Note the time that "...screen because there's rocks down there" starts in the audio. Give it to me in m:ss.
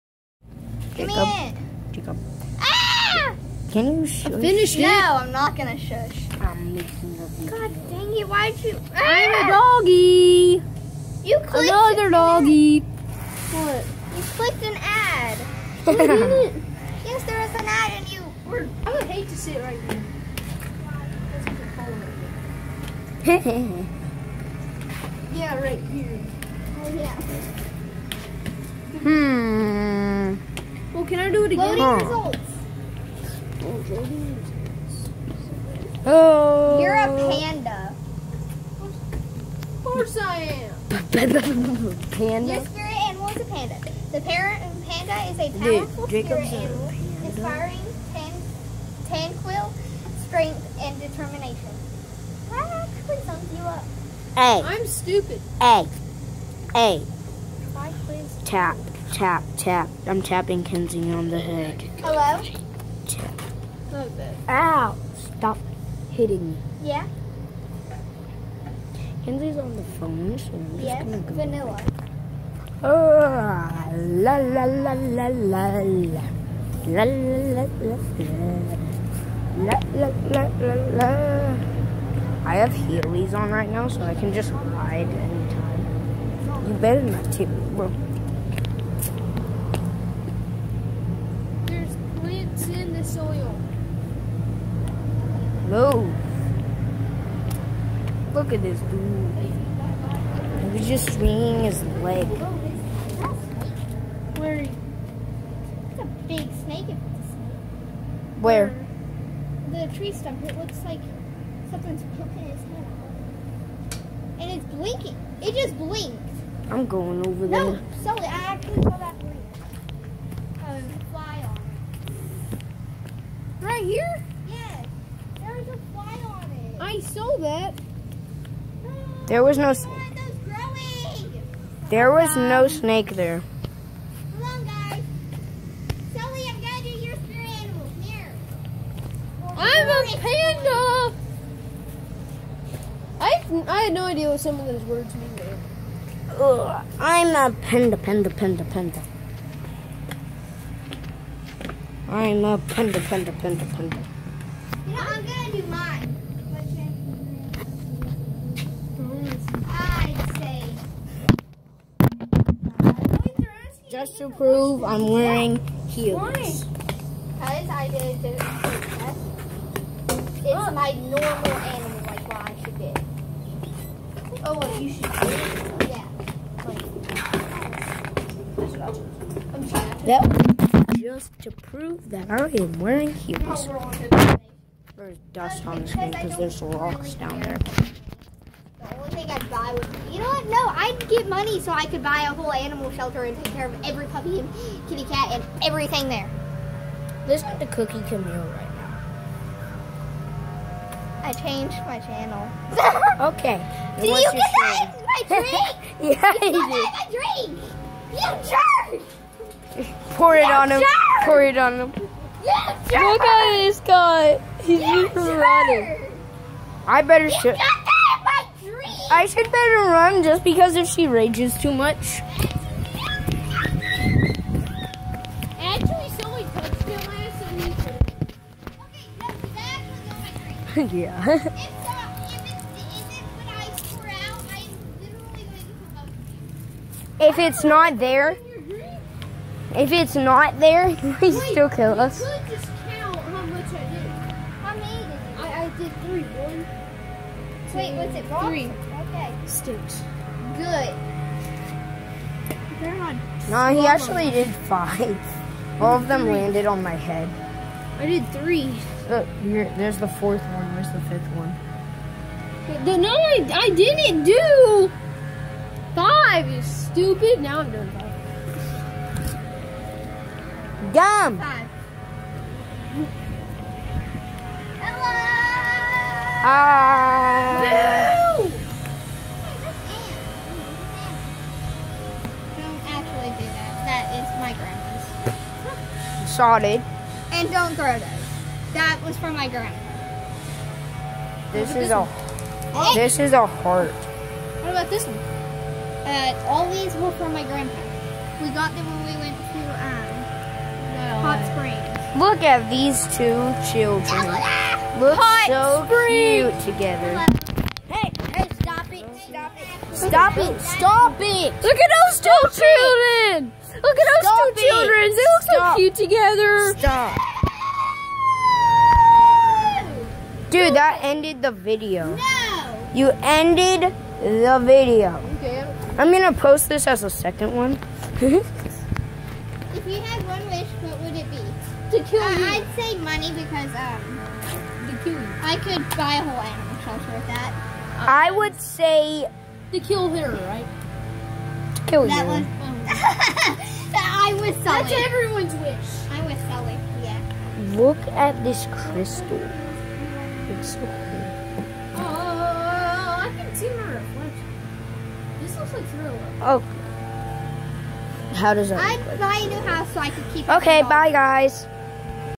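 3:05.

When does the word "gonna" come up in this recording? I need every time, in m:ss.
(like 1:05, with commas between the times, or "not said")
0:05, 1:11, 2:16, 2:35.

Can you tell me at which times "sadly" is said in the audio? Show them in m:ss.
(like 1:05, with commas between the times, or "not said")
not said.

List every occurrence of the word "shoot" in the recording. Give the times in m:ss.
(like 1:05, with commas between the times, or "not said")
3:37.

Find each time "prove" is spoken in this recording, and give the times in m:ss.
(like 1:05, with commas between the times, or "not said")
2:44, 3:01.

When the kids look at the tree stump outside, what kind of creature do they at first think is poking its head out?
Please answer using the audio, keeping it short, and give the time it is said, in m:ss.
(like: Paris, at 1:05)
A snake, at 1:44.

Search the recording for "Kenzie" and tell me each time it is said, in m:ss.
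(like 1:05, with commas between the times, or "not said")
1:00, 1:09.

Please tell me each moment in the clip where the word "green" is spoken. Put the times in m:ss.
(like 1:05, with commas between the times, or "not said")
1:59.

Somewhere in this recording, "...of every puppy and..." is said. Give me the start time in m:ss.
3:13.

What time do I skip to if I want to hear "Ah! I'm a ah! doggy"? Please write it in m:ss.
0:08.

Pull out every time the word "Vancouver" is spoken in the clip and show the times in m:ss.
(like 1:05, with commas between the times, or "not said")
not said.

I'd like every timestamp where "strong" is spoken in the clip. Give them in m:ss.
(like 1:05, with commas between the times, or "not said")
not said.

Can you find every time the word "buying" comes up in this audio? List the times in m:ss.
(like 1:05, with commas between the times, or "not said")
5:59.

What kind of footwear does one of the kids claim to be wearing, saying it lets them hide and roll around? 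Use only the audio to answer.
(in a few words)
Heelys.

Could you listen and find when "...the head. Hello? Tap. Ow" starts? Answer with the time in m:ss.
1:01.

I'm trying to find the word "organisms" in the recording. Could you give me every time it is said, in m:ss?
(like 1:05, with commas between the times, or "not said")
not said.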